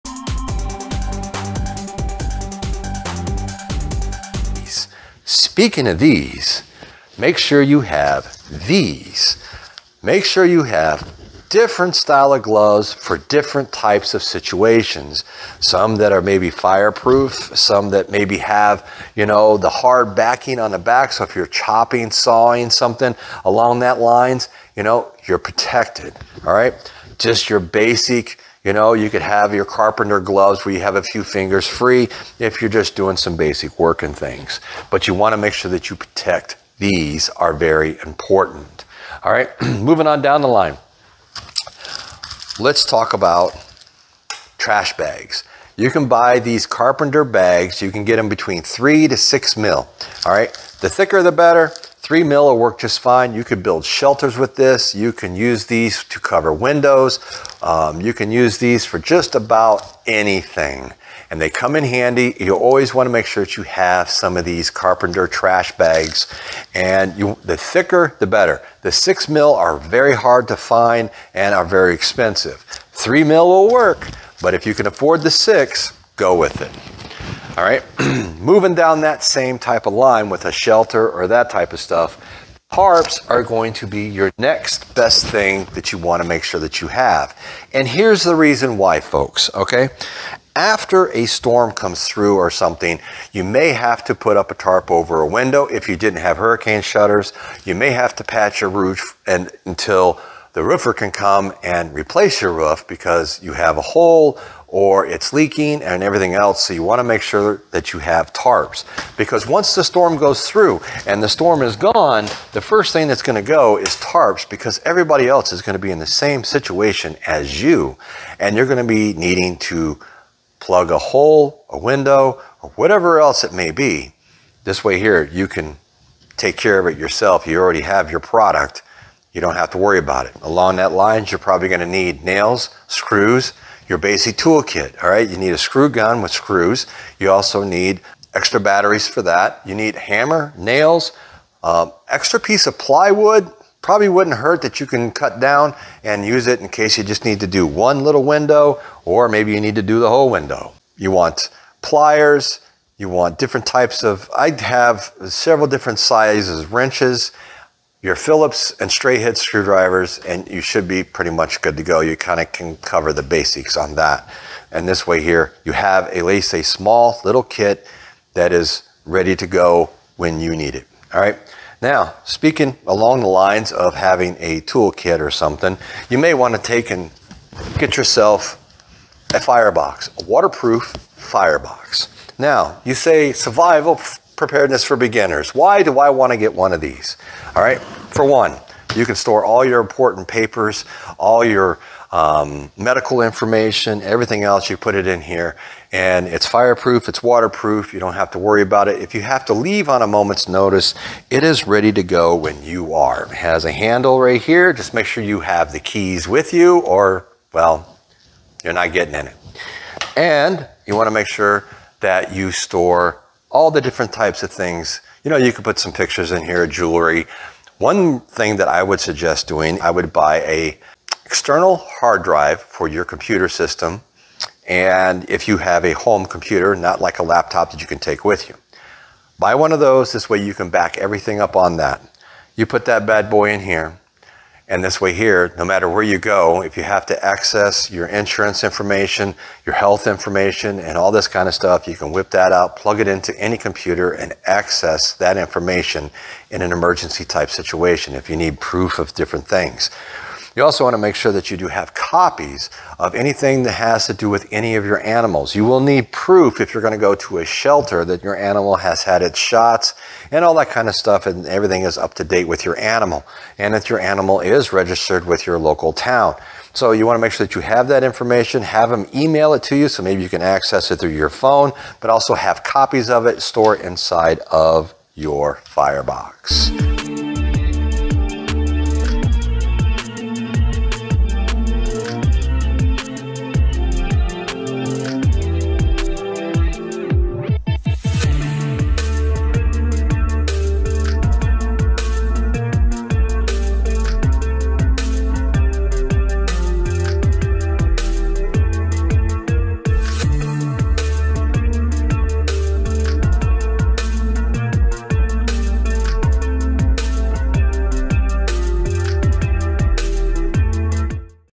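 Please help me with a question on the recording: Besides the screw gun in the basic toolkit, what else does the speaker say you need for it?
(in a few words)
extra batteries.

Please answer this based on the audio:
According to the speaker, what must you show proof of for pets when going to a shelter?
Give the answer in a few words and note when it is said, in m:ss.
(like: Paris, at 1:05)
shots, at 4:19.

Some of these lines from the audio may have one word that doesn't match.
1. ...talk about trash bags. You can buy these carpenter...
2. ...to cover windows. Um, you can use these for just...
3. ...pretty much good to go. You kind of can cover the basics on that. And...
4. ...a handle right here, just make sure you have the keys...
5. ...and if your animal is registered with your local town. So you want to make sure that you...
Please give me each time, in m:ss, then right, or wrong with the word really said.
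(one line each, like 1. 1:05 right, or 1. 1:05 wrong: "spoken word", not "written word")
1. 0:42 right
2. 0:56 right
3. 2:41 right
4. 3:23 right
5. 4:23 right.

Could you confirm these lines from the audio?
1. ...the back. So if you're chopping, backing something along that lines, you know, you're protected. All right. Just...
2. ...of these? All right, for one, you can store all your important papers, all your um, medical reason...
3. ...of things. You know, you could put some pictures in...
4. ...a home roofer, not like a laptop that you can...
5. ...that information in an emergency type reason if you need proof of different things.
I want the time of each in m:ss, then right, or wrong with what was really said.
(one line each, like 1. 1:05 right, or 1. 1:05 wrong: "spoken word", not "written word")
1. 0:20 wrong: "sawing", not "backing"
2. 3:06 wrong: "information", not "reason"
3. 3:34 right
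4. 3:45 wrong: "computer", not "roofer"
5. 4:05 wrong: "situation", not "reason".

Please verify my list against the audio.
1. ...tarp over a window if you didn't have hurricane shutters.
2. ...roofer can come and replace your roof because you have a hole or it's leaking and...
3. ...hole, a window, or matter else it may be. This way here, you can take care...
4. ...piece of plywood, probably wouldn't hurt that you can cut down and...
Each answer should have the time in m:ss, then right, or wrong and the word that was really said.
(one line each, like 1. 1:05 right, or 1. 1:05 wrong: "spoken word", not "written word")
1. 1:34 right
2. 1:40 right
3. 2:00 wrong: "whatever", not "matter"
4. 2:22 right.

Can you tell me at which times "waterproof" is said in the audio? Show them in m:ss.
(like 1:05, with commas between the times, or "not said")
3:00, 3:17.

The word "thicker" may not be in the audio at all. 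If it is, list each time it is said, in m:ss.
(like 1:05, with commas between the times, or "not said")
0:50, 1:07.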